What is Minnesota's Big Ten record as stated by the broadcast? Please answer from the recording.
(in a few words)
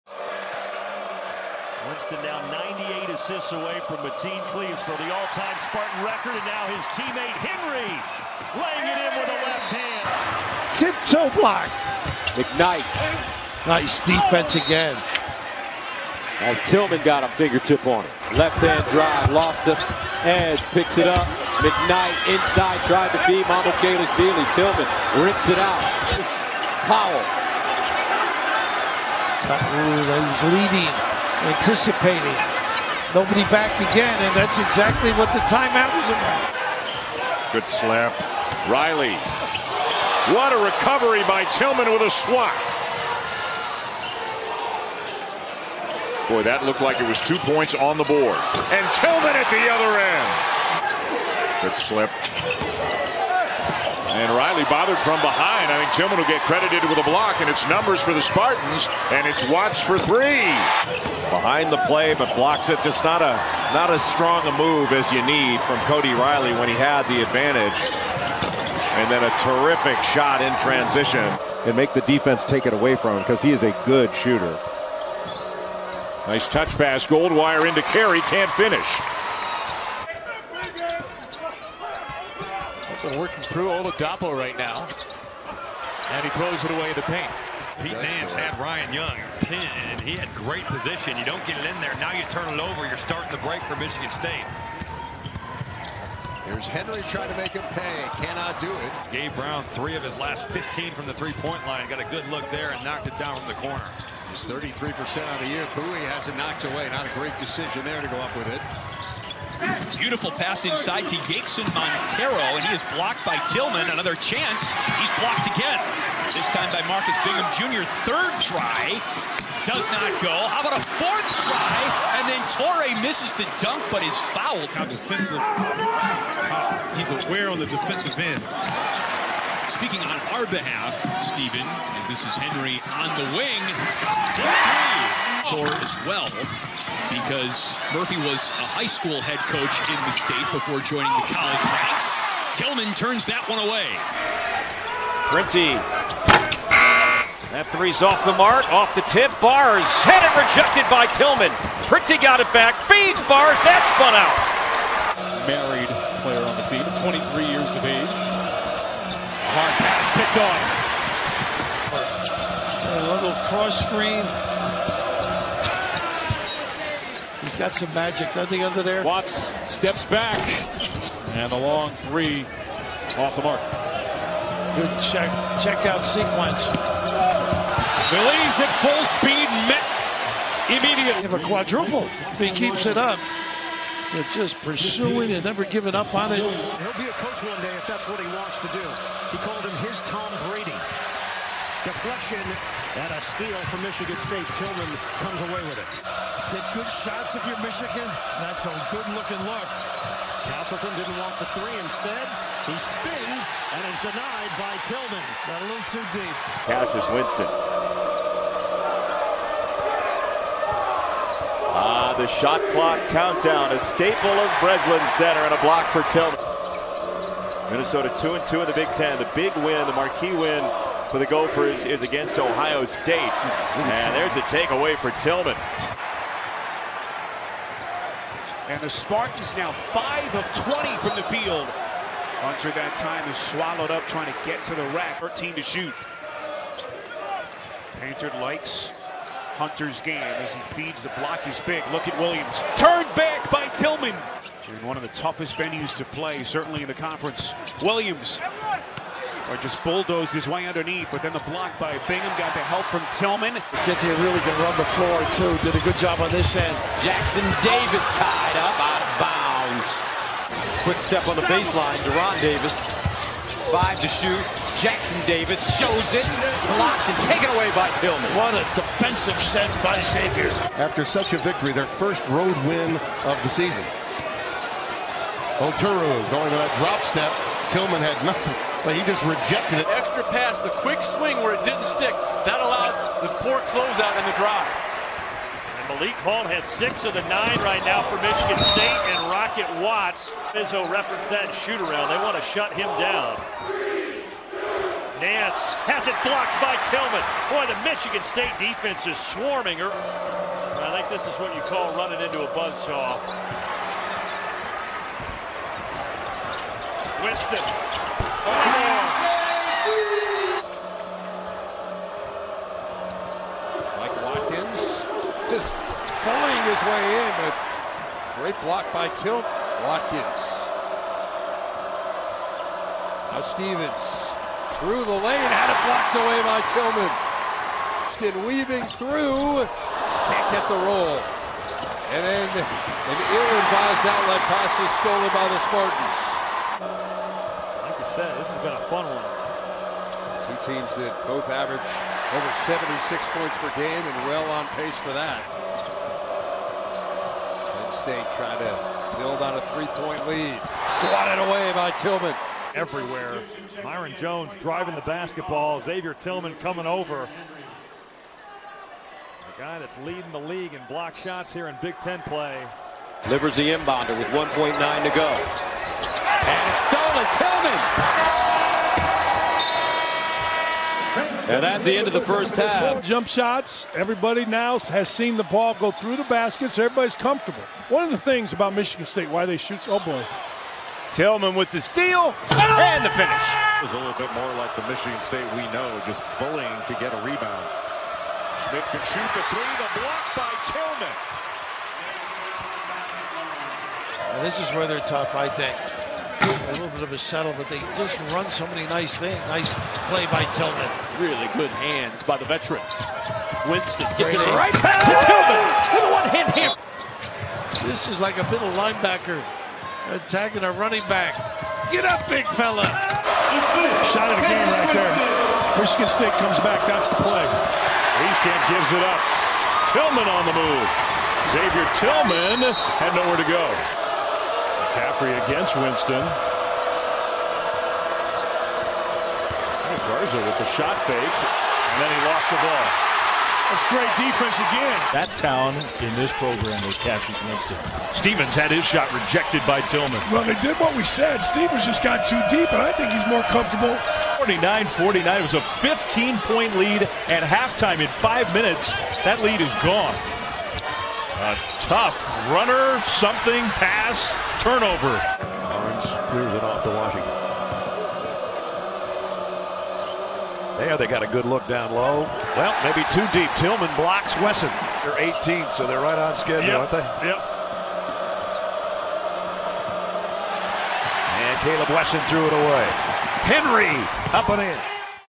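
2 and 2.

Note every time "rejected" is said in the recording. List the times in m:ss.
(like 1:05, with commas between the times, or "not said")
2:30, 4:39, 7:19.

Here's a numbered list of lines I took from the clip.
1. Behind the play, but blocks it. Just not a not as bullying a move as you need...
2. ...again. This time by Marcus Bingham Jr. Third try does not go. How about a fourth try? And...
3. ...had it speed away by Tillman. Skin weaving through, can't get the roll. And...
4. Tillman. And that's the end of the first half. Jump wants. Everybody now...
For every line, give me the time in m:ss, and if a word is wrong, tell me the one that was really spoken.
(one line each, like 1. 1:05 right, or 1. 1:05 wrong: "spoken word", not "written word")
1. 1:01 wrong: "strong", not "bullying"
2. 1:55 right
3. 5:25 wrong: "blocked", not "speed"
4. 6:07 wrong: "shots", not "wants".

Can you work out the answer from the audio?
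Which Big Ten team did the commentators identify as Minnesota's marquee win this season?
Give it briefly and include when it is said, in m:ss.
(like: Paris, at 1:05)
Ohio State, at 3:42.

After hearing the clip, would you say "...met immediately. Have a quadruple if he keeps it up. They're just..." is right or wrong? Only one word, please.
right.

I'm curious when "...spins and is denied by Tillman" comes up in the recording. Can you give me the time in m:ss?
3:22.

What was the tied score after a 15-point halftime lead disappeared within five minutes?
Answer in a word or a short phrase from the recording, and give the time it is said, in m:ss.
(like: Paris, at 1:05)
49-49, at 7:24.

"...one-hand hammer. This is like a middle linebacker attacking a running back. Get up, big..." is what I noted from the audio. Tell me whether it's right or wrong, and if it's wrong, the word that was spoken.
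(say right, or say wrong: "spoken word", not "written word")
right.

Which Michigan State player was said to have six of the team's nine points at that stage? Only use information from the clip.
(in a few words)
Malik Hall.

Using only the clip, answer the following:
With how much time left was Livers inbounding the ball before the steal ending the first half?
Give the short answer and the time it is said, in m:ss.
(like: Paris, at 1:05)
1.9, at 6:04.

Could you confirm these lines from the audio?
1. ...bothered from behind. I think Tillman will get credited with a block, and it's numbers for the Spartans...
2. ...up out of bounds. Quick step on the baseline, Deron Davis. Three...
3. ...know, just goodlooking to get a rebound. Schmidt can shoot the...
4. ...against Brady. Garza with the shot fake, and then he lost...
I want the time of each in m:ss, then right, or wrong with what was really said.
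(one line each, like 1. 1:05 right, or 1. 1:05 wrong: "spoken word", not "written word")
1. 0:54 right
2. 4:18 wrong: "Five", not "Three"
3. 6:25 wrong: "bullying", not "goodlooking"
4. 7:05 wrong: "Winston", not "Brady".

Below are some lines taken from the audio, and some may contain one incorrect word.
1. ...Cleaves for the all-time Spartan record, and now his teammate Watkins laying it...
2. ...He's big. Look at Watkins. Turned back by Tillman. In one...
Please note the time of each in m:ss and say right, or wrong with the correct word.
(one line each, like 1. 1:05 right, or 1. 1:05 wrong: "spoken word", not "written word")
1. 0:04 wrong: "Henry", not "Watkins"
2. 4:01 wrong: "Williams", not "Watkins".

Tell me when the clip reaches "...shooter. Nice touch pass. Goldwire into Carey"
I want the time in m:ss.
1:14.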